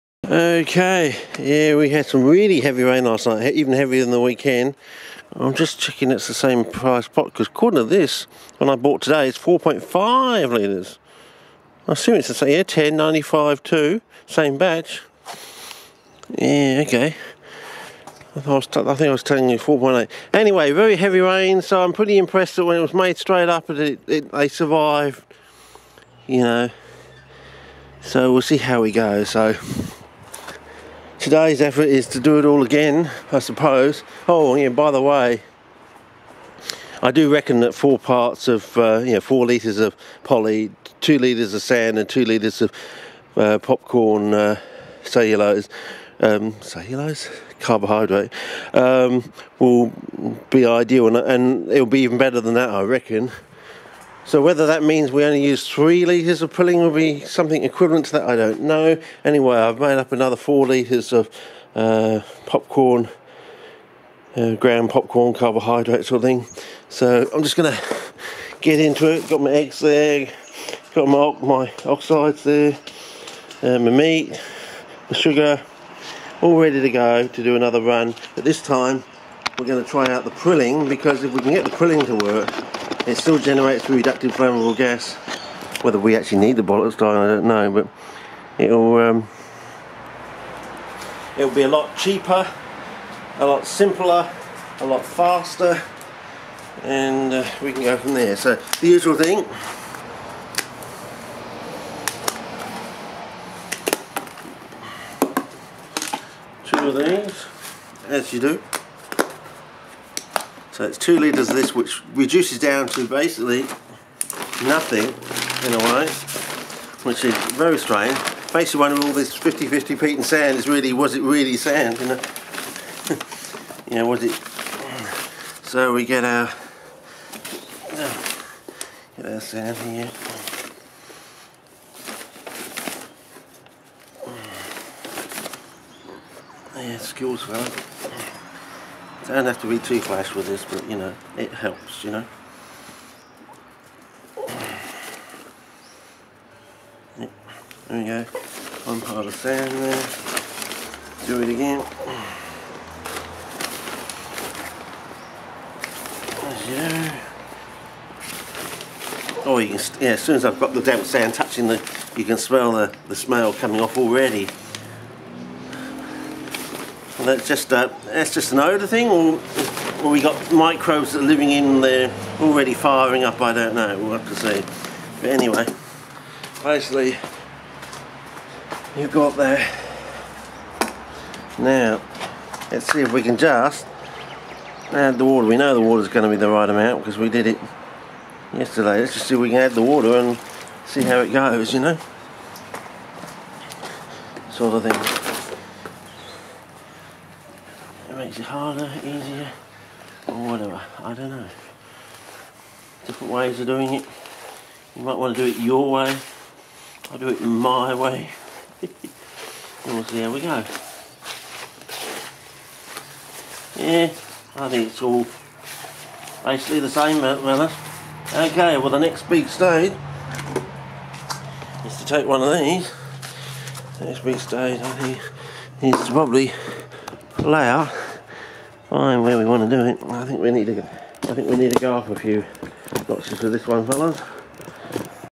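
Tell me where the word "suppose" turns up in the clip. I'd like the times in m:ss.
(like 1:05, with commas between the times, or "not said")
0:33.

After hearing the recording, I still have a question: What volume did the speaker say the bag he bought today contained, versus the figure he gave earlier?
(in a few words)
4.5 litres.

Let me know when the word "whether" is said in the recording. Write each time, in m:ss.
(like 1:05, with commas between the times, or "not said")
0:54, 1:25.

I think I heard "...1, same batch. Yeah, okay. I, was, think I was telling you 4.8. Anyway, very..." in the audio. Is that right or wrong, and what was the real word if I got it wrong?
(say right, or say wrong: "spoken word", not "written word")
wrong: "2", not "1".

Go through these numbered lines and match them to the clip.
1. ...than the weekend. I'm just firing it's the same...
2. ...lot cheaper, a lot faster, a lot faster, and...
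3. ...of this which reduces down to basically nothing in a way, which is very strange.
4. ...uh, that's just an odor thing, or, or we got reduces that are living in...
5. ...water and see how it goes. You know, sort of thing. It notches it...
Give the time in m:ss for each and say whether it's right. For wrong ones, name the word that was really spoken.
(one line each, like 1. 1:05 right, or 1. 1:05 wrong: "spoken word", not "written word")
1. 0:04 wrong: "checking", not "firing"
2. 1:31 wrong: "simpler", not "faster"
3. 1:51 right
4. 2:47 wrong: "microbes", not "reduces"
5. 3:09 wrong: "makes", not "notches".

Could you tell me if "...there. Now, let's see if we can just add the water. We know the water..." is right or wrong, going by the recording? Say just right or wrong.
right.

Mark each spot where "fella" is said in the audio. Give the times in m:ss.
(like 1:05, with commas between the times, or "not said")
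2:17, 3:53.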